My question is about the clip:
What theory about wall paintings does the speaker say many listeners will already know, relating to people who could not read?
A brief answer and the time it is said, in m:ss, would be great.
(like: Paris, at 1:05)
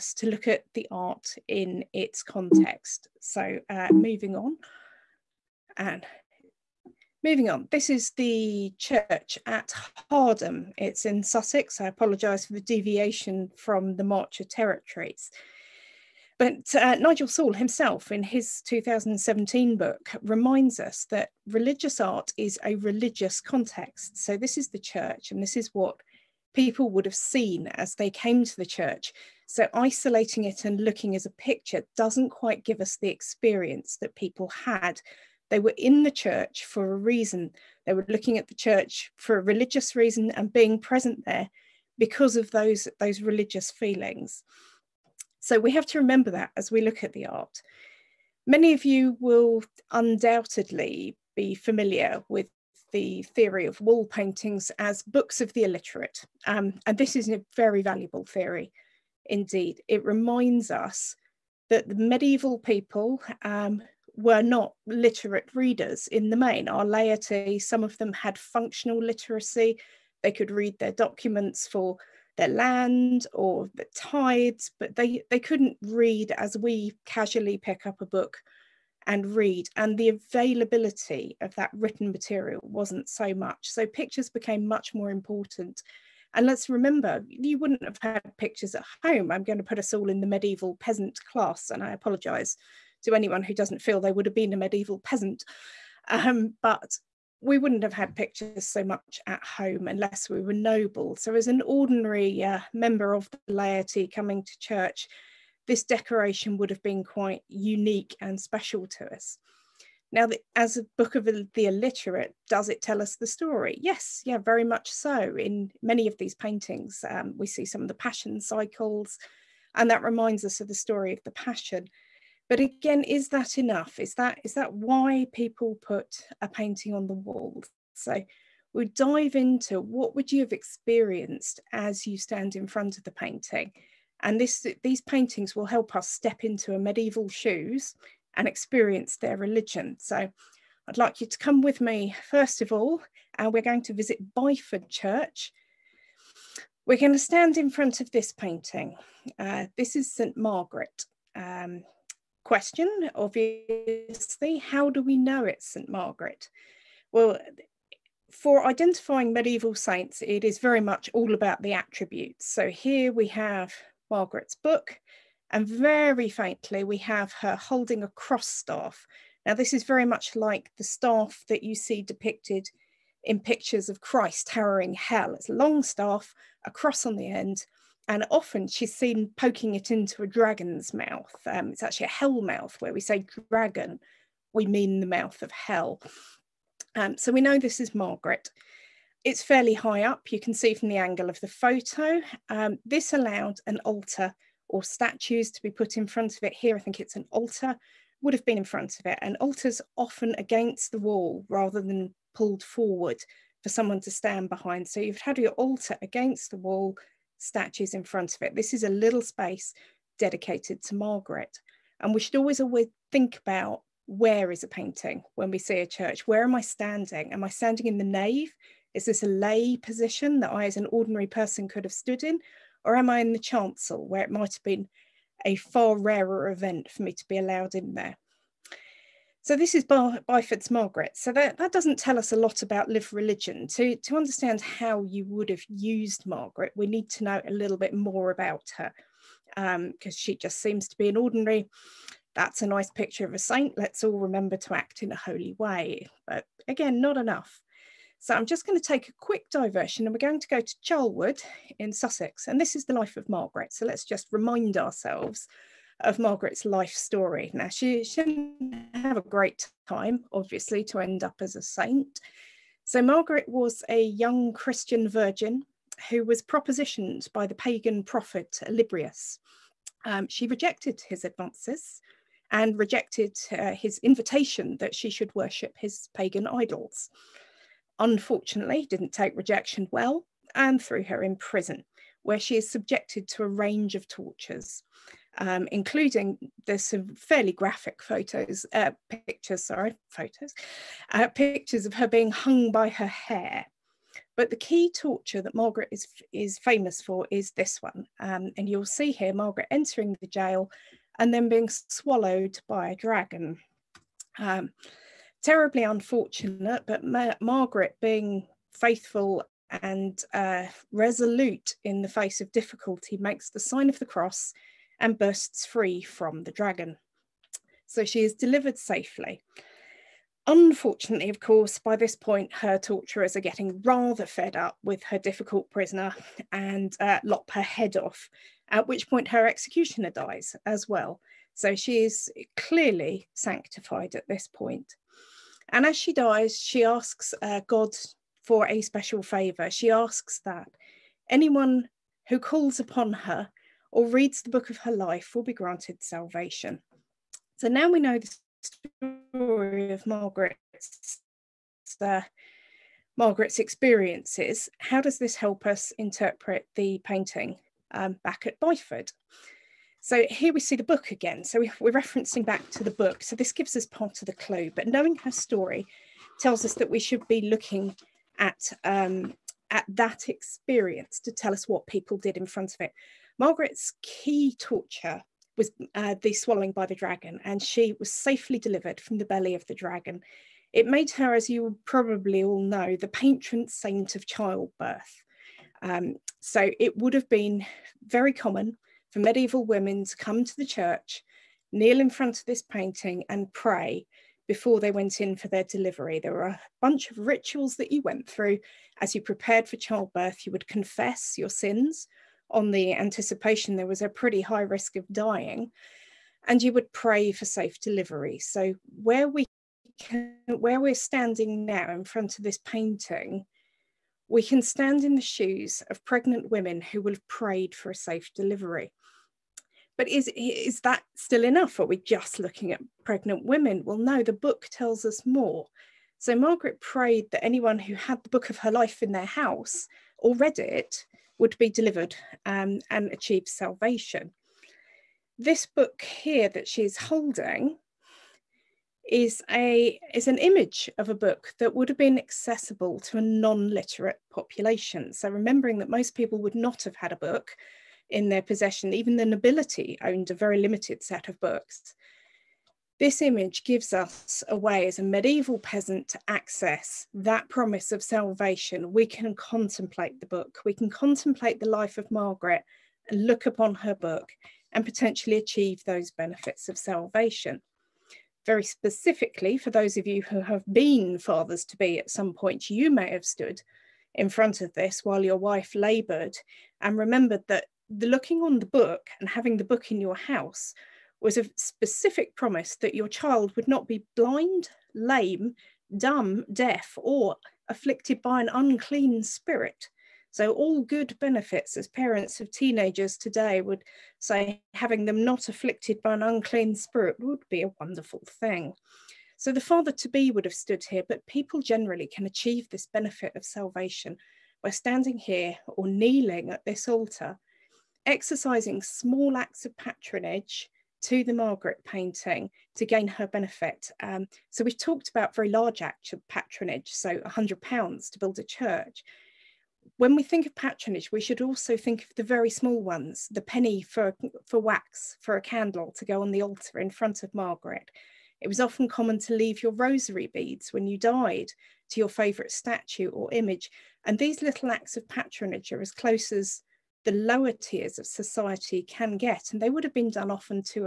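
books of the illiterate, at 0:55.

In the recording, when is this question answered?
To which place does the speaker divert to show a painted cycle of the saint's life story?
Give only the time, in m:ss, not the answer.
4:10.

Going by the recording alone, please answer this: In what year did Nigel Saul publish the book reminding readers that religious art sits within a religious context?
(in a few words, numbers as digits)
2017.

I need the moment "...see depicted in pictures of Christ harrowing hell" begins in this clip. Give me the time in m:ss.
2:51.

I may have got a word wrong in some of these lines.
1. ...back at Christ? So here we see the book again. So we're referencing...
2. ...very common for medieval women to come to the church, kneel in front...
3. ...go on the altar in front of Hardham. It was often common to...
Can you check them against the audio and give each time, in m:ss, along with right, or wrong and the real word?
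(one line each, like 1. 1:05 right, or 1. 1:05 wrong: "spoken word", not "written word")
1. 5:58 wrong: "Byford", not "Christ"
2. 6:28 right
3. 8:46 wrong: "Margaret", not "Hardham".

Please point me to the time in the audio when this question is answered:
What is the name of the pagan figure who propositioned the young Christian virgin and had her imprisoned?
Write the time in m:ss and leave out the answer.
4:28.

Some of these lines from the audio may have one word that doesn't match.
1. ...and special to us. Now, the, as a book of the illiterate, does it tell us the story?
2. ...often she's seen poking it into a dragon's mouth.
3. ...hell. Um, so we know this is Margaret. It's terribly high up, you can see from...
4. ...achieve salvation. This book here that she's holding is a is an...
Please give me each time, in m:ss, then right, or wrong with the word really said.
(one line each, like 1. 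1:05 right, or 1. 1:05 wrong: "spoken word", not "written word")
1. 1:48 right
2. 2:58 right
3. 3:05 wrong: "fairly", not "terribly"
4. 7:13 right.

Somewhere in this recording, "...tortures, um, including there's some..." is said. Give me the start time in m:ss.
4:44.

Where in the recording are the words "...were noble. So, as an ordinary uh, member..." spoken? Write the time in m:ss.
1:40.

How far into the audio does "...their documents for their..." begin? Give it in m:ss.
1:10.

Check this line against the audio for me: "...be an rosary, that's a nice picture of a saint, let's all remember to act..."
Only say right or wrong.
wrong.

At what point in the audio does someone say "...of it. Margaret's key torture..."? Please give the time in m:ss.
6:12.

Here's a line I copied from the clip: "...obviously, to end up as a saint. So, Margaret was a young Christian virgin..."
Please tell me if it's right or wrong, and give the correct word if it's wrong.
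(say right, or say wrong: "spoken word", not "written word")
right.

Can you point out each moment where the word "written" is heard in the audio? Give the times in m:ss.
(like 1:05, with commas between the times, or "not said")
1:21.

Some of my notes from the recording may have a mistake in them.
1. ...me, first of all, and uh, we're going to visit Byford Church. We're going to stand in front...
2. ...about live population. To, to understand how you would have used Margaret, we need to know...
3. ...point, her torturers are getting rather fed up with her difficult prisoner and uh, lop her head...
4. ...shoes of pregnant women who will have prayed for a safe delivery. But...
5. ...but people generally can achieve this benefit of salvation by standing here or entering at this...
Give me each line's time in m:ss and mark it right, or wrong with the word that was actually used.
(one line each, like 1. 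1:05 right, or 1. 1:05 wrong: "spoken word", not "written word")
1. 2:21 right
2. 3:52 wrong: "religion", not "population"
3. 5:22 right
4. 6:55 right
5. 8:21 wrong: "kneeling", not "entering".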